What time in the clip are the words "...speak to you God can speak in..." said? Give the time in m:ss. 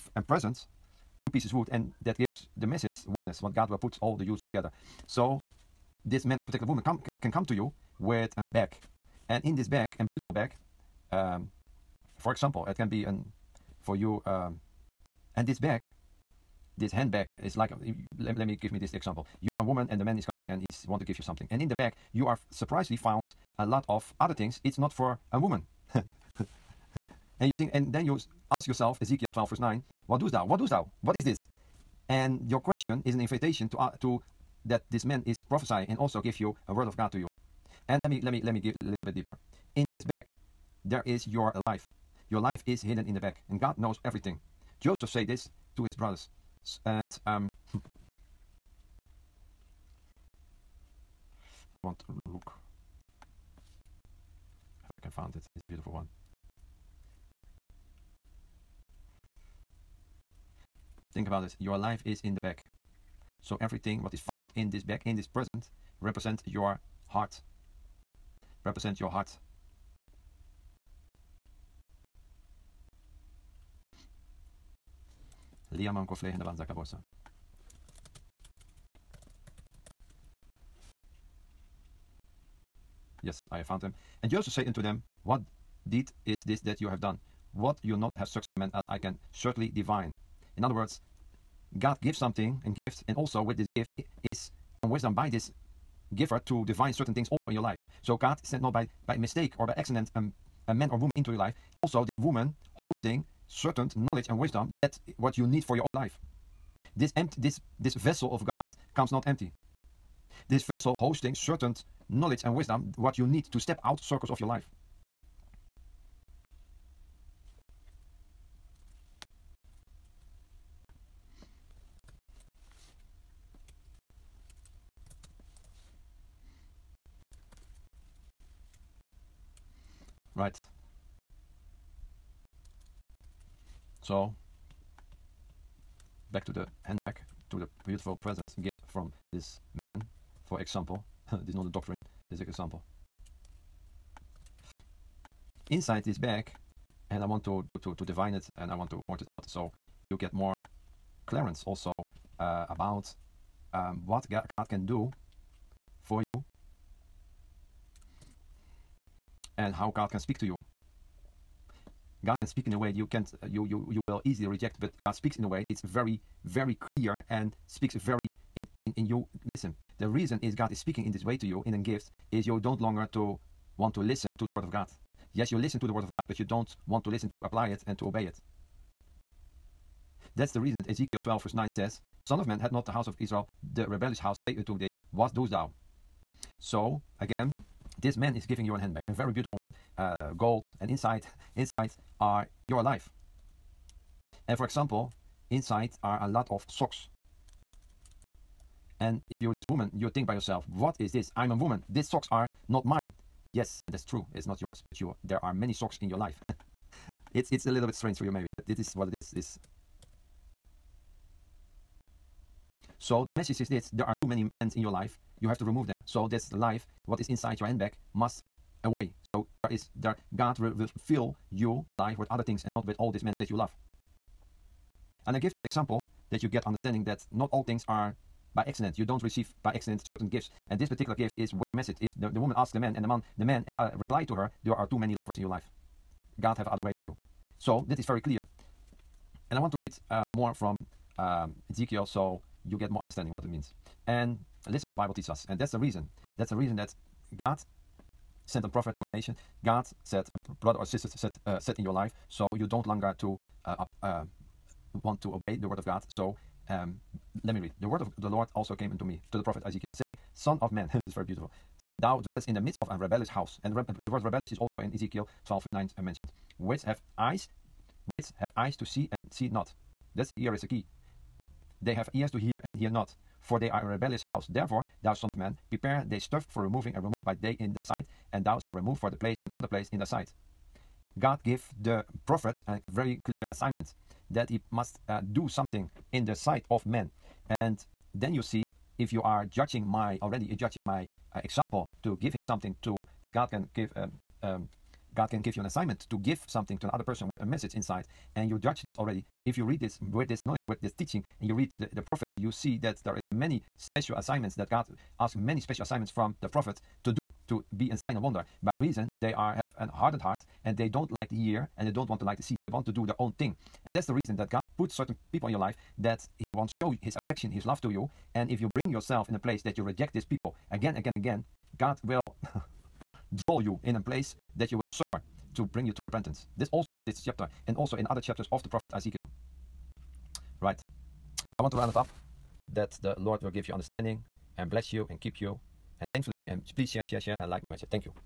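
2:40.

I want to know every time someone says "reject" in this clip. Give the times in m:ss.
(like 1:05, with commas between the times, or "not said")
2:44, 5:19.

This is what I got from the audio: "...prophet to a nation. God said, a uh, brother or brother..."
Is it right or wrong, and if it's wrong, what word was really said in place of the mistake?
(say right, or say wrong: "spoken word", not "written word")
wrong: "sister", not "brother".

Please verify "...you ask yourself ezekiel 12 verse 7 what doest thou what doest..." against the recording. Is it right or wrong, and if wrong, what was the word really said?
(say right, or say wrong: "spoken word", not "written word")
wrong: "9", not "7".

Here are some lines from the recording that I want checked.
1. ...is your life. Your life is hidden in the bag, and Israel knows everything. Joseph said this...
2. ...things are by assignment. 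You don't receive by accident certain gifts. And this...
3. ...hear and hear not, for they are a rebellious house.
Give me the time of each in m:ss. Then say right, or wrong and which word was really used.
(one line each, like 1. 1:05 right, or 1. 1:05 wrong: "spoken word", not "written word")
1. 0:41 wrong: "God", not "Israel"
2. 3:47 wrong: "accident", not "assignment"
3. 4:32 right.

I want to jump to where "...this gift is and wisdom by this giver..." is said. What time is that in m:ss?
1:33.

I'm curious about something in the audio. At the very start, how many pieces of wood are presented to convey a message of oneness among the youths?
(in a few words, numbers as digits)
2.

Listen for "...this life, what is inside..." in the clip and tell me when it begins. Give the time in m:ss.
3:36.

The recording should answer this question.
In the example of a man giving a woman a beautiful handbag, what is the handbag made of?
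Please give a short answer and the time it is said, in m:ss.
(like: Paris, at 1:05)
gold, at 3:10.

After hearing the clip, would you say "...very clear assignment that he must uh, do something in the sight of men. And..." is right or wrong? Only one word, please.
right.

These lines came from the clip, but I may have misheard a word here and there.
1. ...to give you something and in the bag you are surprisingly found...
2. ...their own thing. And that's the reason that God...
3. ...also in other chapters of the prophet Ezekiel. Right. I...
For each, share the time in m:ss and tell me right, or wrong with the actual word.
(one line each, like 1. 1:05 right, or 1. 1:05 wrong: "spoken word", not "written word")
1. 0:20 right
2. 5:13 right
3. 5:27 right.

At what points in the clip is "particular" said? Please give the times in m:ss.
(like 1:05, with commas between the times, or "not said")
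0:06, 3:50.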